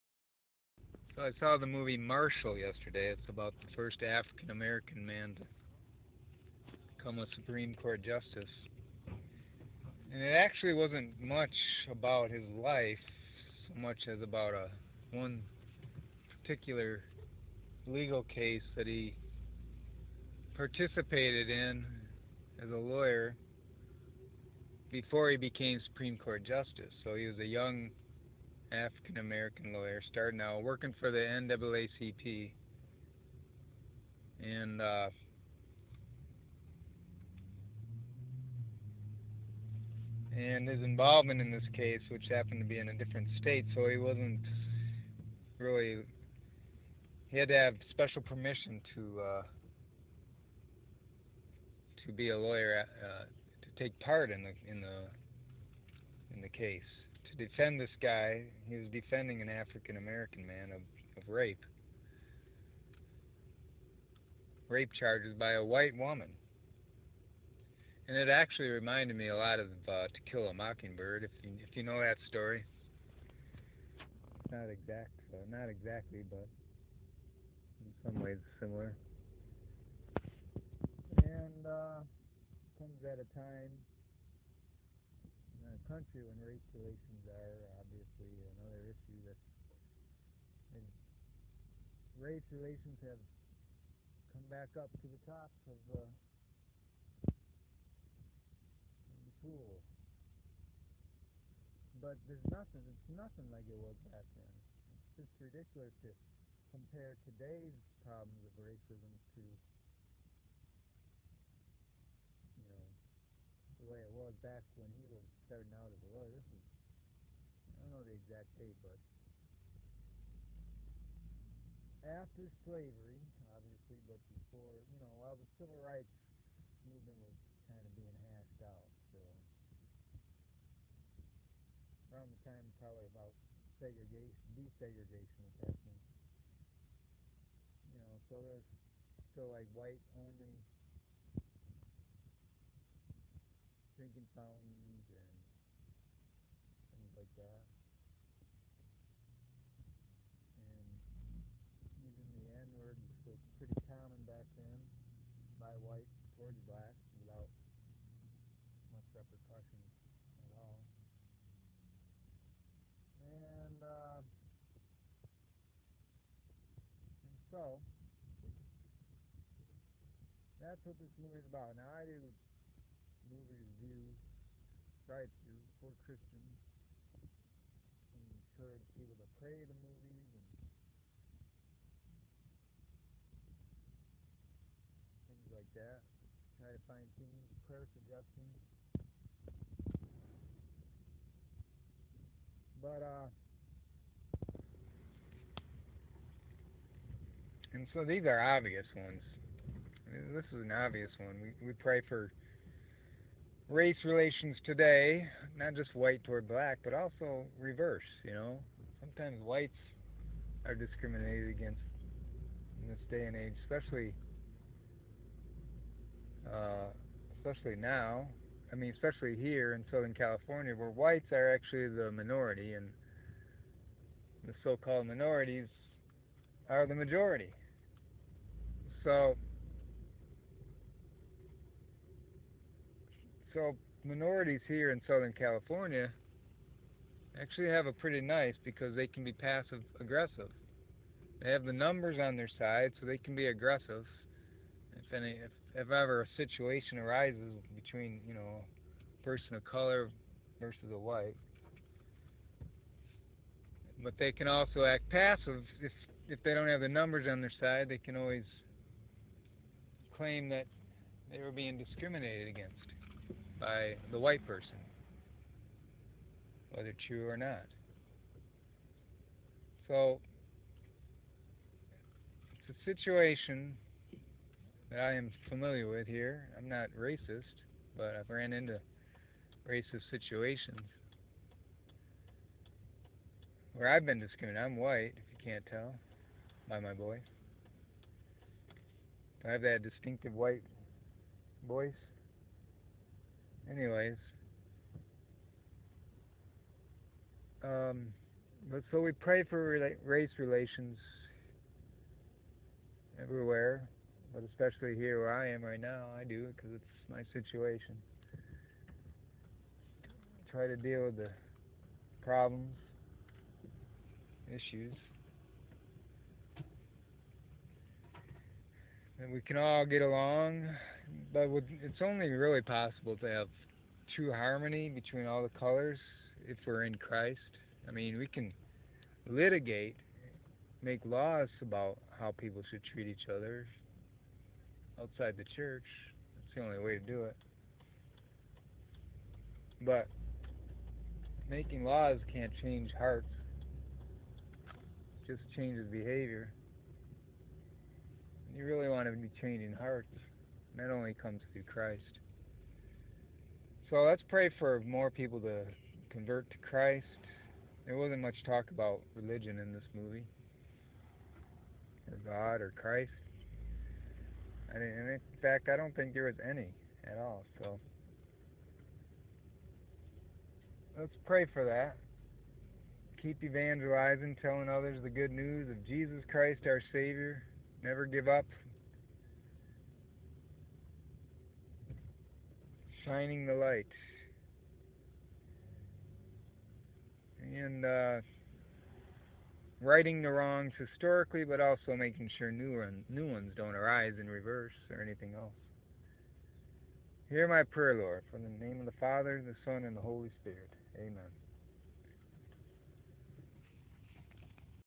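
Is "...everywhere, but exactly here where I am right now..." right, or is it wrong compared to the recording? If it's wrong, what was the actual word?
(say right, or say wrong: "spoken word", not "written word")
wrong: "especially", not "exactly".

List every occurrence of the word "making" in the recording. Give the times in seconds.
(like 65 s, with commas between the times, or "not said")
341 s, 391 s.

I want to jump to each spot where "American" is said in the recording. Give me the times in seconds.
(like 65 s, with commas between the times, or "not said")
4 s, 29 s, 59 s.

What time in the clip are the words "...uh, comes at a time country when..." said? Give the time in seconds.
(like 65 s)
81 s.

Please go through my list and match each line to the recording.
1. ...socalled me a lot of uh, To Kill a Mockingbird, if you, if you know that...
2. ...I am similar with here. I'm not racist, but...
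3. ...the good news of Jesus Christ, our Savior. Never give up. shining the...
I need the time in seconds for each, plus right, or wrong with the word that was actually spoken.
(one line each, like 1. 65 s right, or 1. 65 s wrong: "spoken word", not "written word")
1. 68 s wrong: "reminded", not "socalled"
2. 274 s wrong: "familiar", not "similar"
3. 375 s right.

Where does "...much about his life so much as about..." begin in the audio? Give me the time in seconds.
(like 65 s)
11 s.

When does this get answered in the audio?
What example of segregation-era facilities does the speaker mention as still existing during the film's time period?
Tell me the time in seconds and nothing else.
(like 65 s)
139 s.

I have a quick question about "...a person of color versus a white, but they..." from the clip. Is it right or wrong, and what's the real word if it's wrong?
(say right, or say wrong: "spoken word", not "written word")
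right.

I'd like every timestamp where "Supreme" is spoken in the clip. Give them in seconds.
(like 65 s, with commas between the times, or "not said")
7 s, 25 s.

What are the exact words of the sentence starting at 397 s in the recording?
Hear my prayer, Lord, for the name of the Father, the Son, and the Holy Spirit.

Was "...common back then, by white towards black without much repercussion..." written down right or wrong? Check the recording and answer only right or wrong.
right.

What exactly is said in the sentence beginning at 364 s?
I in fact, I don't think there was any at all.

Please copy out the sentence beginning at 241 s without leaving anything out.
They have the numbers on their side, so they can be aggressive.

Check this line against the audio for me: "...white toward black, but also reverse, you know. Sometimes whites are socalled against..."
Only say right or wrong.
wrong.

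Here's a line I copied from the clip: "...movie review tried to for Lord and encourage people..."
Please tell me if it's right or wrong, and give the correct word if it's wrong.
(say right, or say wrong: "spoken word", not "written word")
wrong: "Christians", not "Lord".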